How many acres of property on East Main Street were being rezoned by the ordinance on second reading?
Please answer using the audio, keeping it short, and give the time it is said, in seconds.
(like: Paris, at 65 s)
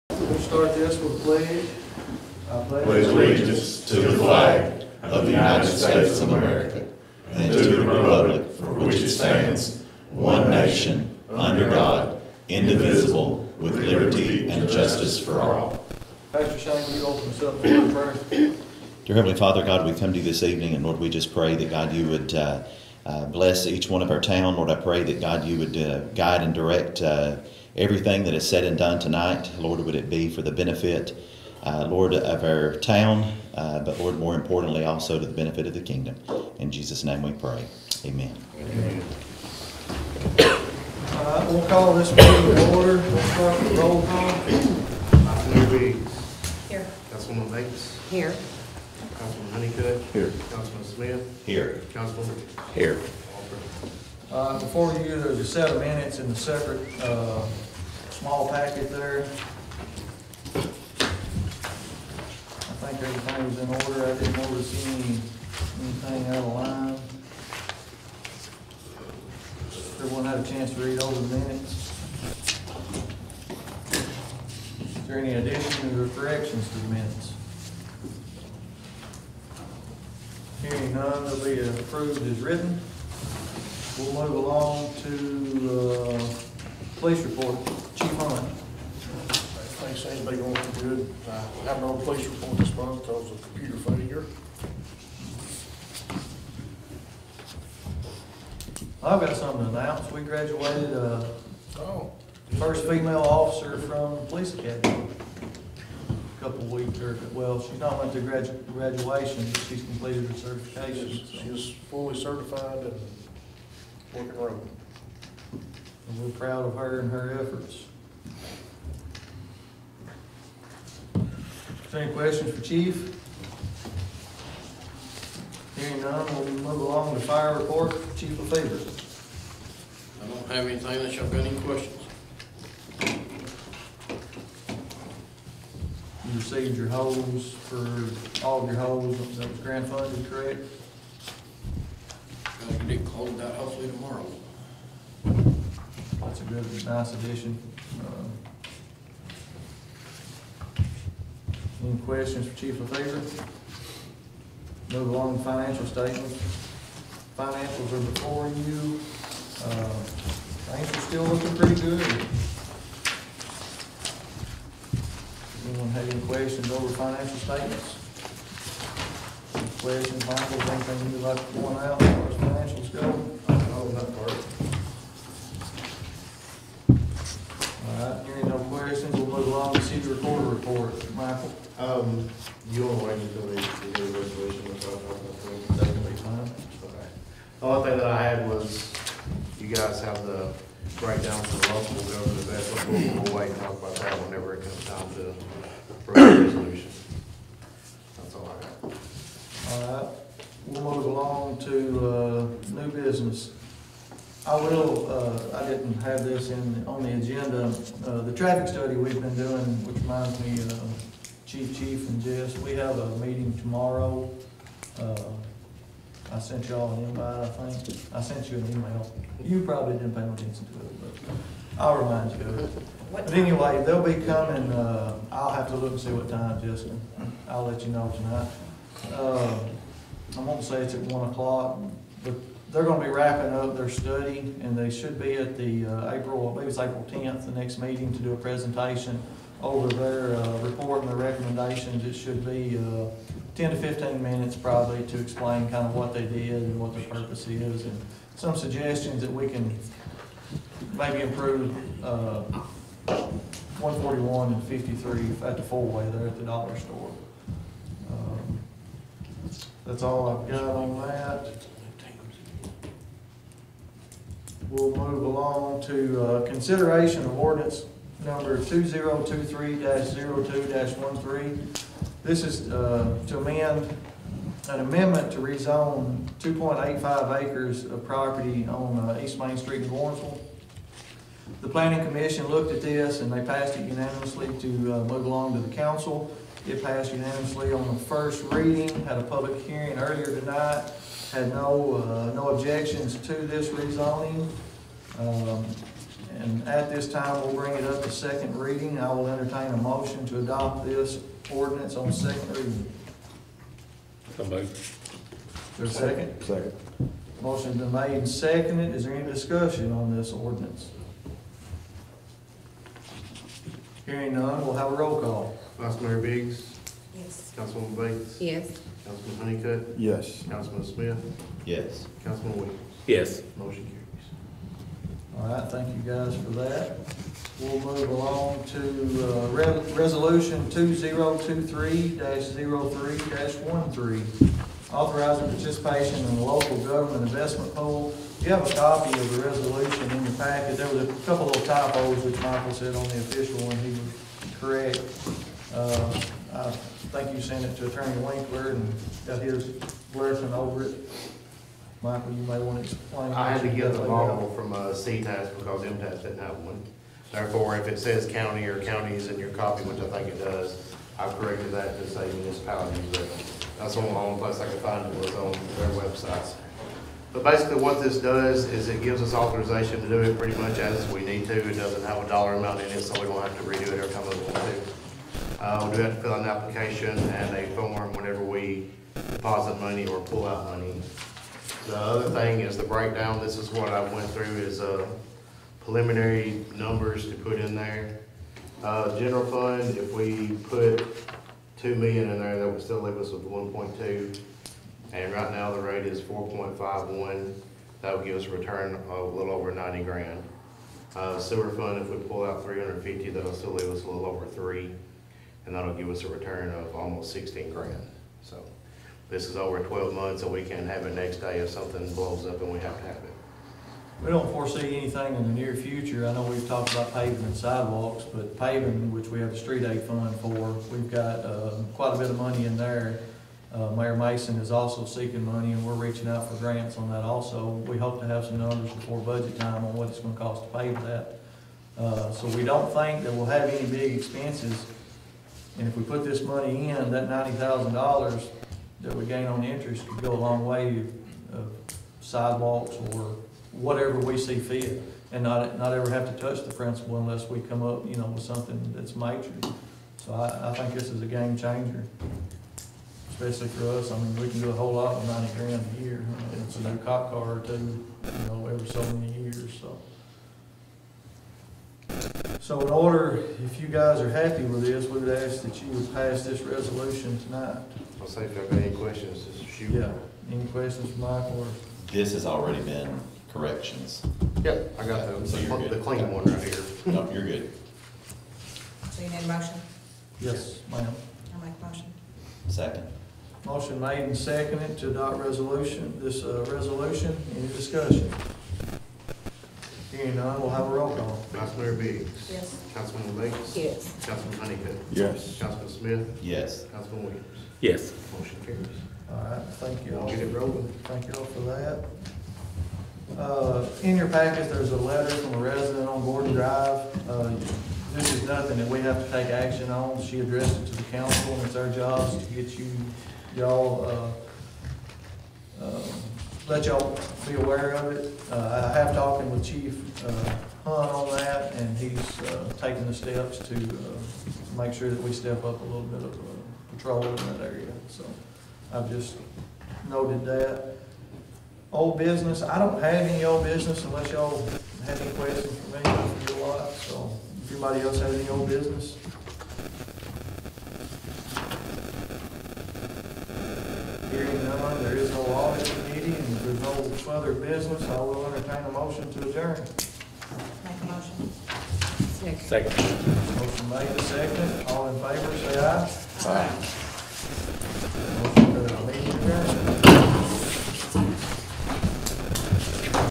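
2.85, at 276 s.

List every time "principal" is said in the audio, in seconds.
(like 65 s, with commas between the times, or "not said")
446 s.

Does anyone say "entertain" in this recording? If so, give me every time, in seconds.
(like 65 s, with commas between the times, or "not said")
299 s, 548 s.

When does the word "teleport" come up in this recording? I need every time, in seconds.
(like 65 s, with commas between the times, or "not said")
not said.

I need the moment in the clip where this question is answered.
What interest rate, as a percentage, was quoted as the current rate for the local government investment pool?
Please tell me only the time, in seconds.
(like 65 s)
396 s.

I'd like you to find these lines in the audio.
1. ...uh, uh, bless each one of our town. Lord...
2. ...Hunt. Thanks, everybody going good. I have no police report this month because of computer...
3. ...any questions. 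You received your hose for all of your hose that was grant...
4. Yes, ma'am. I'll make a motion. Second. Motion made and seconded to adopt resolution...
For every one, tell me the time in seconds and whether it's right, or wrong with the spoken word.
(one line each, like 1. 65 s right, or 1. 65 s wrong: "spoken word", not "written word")
1. 22 s right
2. 88 s right
3. 131 s right
4. 480 s right.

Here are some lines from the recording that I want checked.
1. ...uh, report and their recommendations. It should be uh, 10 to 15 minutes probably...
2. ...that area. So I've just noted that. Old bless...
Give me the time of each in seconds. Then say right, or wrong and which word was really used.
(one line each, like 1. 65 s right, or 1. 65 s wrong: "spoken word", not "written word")
1. 240 s right
2. 527 s wrong: "business", not "bless".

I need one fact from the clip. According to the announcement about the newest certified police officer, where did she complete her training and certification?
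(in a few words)
police academy.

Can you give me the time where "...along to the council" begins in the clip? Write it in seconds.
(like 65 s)
285 s.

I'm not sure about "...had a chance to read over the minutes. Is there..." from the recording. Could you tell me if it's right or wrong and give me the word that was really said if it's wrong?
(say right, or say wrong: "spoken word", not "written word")
right.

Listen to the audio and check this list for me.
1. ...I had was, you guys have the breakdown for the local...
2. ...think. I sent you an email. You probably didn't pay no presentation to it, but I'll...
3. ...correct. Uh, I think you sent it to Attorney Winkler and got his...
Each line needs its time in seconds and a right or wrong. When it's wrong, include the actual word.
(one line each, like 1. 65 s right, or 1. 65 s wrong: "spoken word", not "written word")
1. 188 s right
2. 217 s wrong: "attention", not "presentation"
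3. 344 s right.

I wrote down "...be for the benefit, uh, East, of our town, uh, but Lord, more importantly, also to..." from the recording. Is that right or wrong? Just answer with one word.
wrong.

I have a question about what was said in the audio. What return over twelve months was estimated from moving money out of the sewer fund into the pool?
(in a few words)
almost 16 grand.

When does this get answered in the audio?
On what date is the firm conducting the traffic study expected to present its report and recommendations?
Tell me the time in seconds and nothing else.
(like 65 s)
236 s.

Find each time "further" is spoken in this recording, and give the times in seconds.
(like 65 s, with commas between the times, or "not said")
547 s.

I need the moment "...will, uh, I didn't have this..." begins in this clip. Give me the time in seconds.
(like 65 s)
204 s.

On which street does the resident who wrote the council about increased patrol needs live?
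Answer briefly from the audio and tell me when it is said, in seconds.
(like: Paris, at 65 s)
Gordon Drive, at 506 s.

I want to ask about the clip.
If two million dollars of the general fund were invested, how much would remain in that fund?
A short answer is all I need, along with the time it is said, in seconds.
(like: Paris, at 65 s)
1.2 million, at 393 s.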